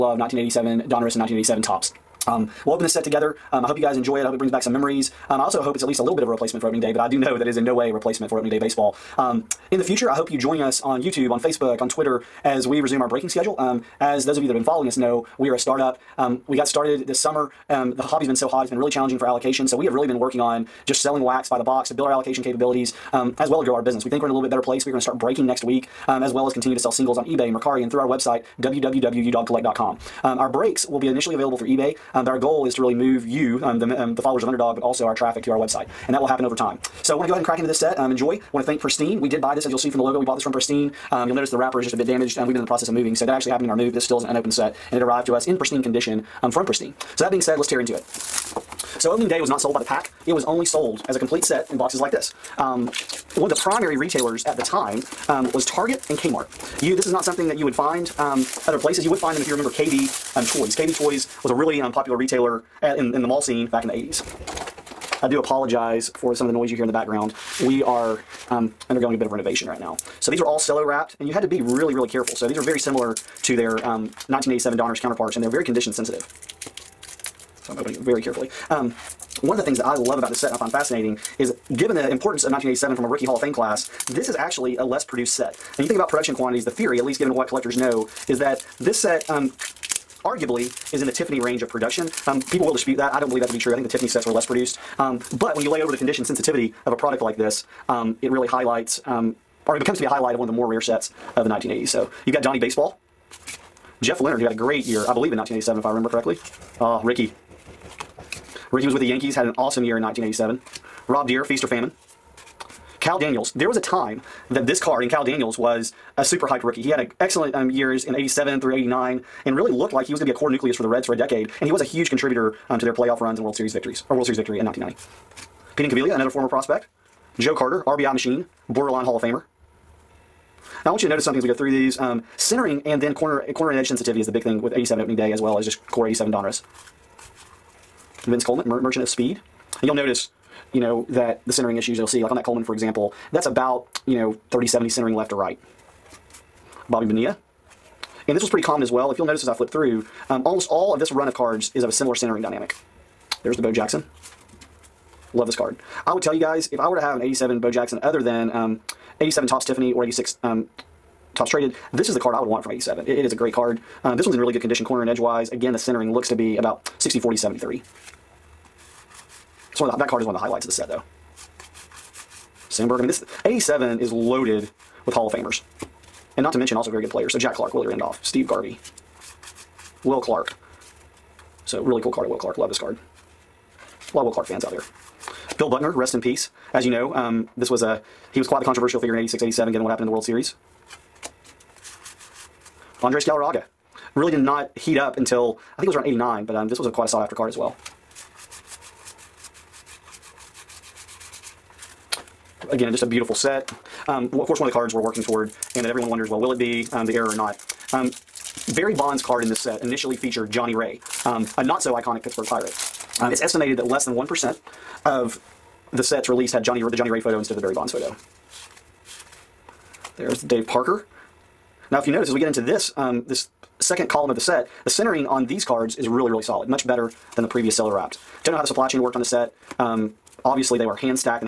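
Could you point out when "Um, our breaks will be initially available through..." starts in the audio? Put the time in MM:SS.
00:30.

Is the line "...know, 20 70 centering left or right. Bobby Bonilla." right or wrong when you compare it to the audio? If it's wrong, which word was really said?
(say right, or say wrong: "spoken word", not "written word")
wrong: "30", not "20".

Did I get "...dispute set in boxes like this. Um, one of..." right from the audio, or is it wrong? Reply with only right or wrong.
wrong.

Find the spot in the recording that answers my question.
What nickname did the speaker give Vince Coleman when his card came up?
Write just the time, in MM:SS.
02:18.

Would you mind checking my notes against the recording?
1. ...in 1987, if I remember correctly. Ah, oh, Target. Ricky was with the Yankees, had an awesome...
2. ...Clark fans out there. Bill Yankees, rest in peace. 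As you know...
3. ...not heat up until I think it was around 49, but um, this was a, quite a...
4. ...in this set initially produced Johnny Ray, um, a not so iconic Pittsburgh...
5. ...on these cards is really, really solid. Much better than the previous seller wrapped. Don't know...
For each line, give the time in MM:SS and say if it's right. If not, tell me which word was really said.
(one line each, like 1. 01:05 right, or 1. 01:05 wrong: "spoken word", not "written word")
1. 01:45 wrong: "Ricky", not "Target"
2. 03:04 wrong: "Buckner", not "Yankees"
3. 03:14 wrong: "89", not "49"
4. 03:29 wrong: "featured", not "produced"
5. 03:45 right.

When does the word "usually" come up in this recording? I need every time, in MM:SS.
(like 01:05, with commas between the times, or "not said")
not said.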